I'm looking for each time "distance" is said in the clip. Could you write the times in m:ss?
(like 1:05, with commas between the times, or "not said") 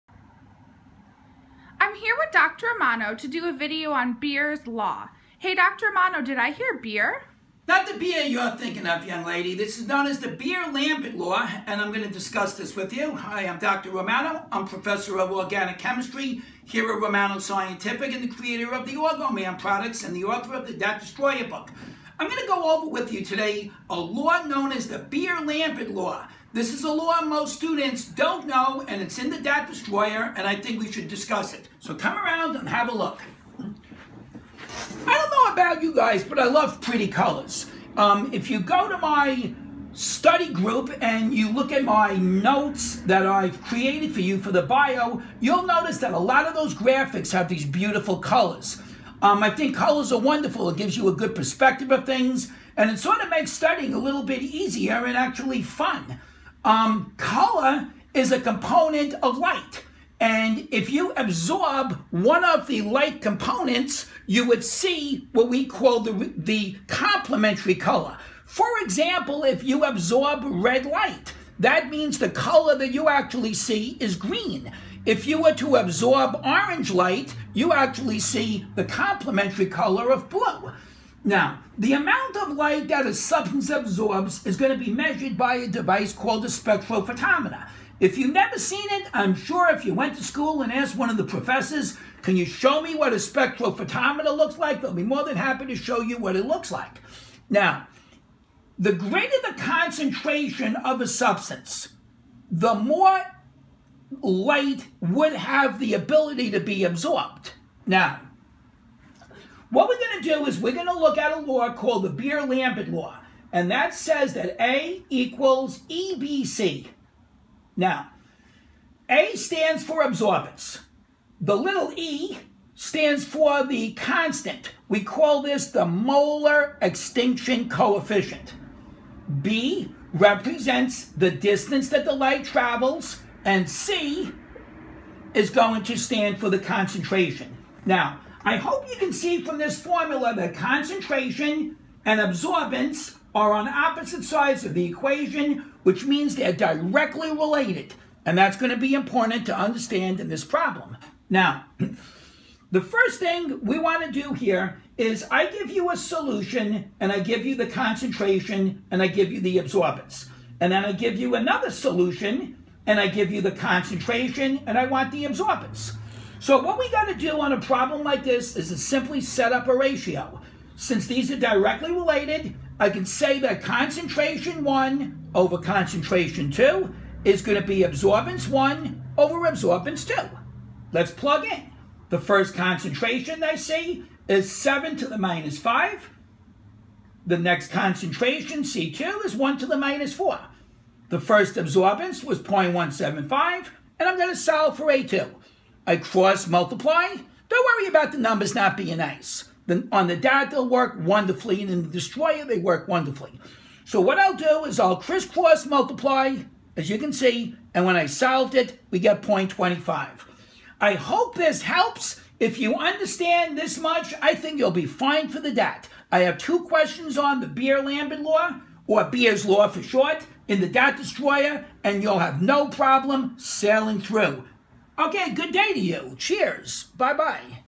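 2:11.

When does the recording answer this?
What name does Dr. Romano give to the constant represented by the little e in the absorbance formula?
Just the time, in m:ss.
2:05.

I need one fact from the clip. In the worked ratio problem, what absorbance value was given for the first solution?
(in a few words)
0.175.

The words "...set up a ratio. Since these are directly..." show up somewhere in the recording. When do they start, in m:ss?
2:49.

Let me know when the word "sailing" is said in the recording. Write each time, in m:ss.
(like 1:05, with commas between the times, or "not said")
3:43.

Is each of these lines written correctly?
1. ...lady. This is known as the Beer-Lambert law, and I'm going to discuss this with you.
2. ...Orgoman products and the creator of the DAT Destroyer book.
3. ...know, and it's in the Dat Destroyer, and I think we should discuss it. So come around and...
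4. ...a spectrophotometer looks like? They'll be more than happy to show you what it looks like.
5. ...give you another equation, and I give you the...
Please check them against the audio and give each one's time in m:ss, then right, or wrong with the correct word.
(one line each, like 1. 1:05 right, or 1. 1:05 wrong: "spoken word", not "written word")
1. 0:09 right
2. 0:18 wrong: "author", not "creator"
3. 0:28 right
4. 1:33 right
5. 2:40 wrong: "solution", not "equation".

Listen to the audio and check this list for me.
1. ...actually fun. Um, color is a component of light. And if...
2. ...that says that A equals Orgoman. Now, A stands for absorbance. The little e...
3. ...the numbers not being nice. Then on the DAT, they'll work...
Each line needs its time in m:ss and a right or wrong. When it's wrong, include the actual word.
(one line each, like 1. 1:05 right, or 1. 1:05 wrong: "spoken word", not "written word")
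1. 0:55 right
2. 1:53 wrong: "EBC", not "Orgoman"
3. 3:18 right.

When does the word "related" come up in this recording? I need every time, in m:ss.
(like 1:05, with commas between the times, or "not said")
2:27, 2:51.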